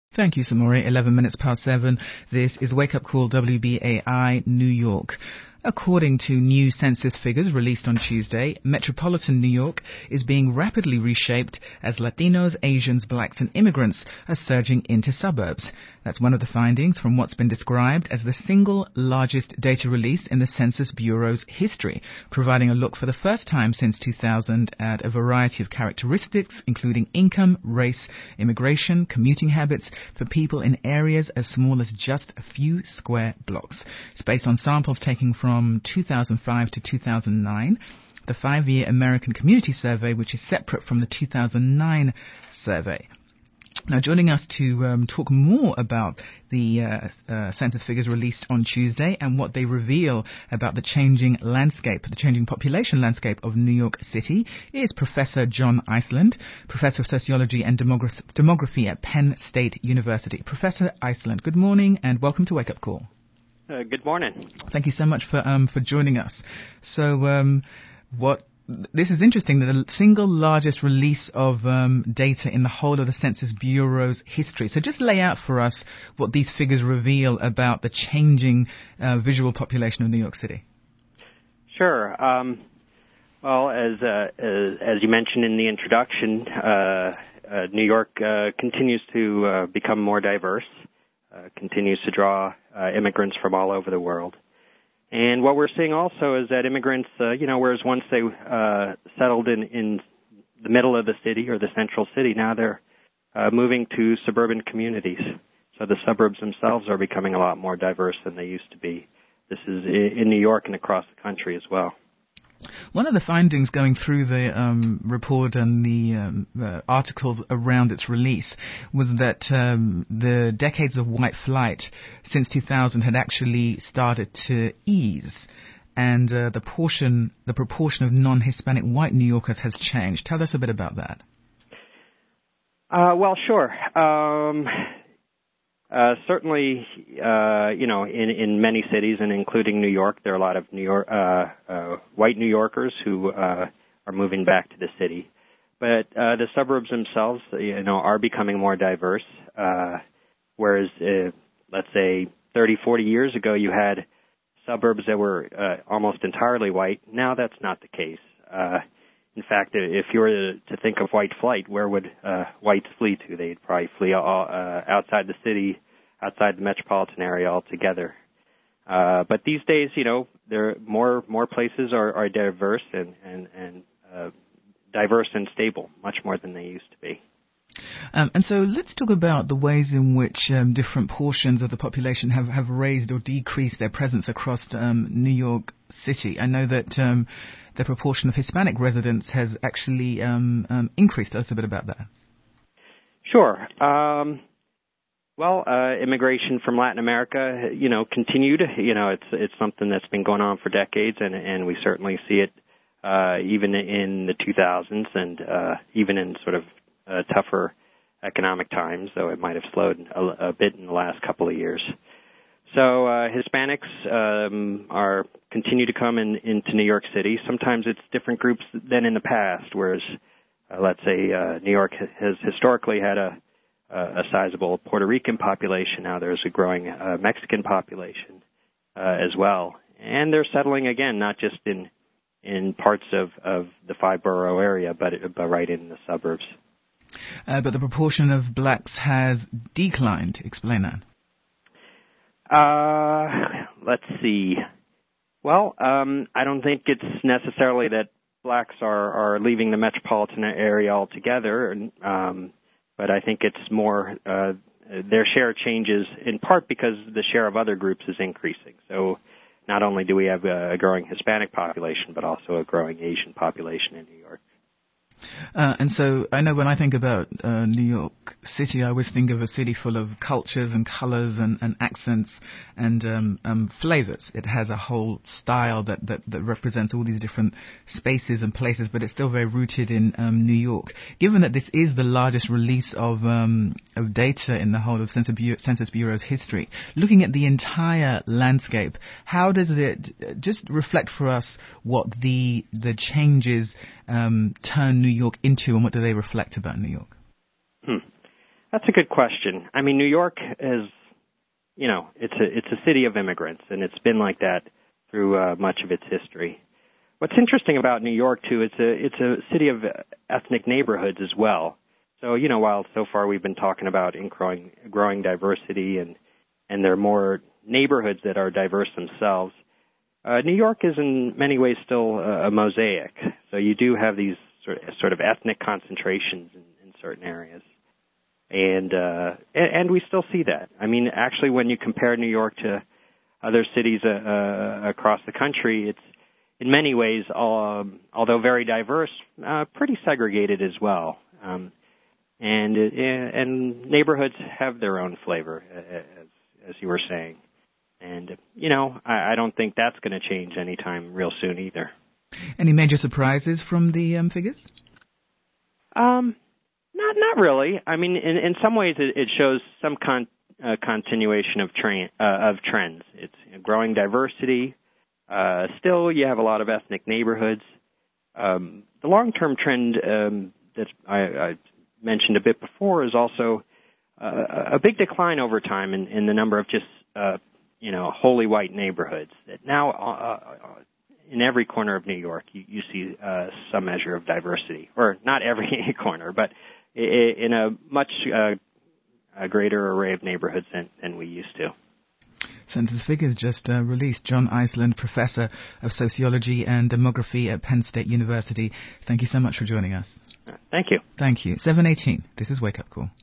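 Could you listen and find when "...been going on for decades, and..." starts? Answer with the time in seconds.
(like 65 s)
200 s.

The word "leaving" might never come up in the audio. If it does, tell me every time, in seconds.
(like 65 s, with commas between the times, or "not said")
249 s.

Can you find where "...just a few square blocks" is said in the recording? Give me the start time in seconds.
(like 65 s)
31 s.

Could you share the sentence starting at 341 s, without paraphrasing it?
Um, and uh, and neighborhoods have their own flavor, as as you were saying.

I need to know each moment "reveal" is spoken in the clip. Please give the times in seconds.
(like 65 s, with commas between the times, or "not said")
49 s, 76 s.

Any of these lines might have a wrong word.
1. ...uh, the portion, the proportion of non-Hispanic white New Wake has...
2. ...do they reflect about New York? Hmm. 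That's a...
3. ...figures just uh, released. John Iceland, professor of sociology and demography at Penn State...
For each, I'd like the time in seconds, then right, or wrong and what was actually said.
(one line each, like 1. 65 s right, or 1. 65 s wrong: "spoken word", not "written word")
1. 126 s wrong: "Yorkers", not "Wake"
2. 295 s right
3. 393 s right.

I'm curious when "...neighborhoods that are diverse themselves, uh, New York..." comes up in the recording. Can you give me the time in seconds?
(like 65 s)
317 s.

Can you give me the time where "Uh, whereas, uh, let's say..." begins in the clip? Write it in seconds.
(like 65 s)
149 s.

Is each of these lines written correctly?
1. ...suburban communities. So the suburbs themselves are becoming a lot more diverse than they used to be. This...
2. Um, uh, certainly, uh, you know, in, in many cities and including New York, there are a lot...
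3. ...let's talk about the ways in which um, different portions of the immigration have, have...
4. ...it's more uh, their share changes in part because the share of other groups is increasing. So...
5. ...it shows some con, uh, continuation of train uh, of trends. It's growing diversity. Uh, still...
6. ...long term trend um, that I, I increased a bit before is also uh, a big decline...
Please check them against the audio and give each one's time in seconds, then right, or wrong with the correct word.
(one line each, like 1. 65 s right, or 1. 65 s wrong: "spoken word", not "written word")
1. 104 s right
2. 133 s right
3. 178 s wrong: "population", not "immigration"
4. 253 s right
5. 359 s right
6. 369 s wrong: "mentioned", not "increased".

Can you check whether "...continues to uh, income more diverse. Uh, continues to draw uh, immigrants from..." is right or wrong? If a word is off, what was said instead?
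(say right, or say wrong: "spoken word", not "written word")
wrong: "become", not "income".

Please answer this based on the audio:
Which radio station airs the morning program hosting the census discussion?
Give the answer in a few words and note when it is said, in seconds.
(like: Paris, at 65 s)
WBAI New York, at 3 s.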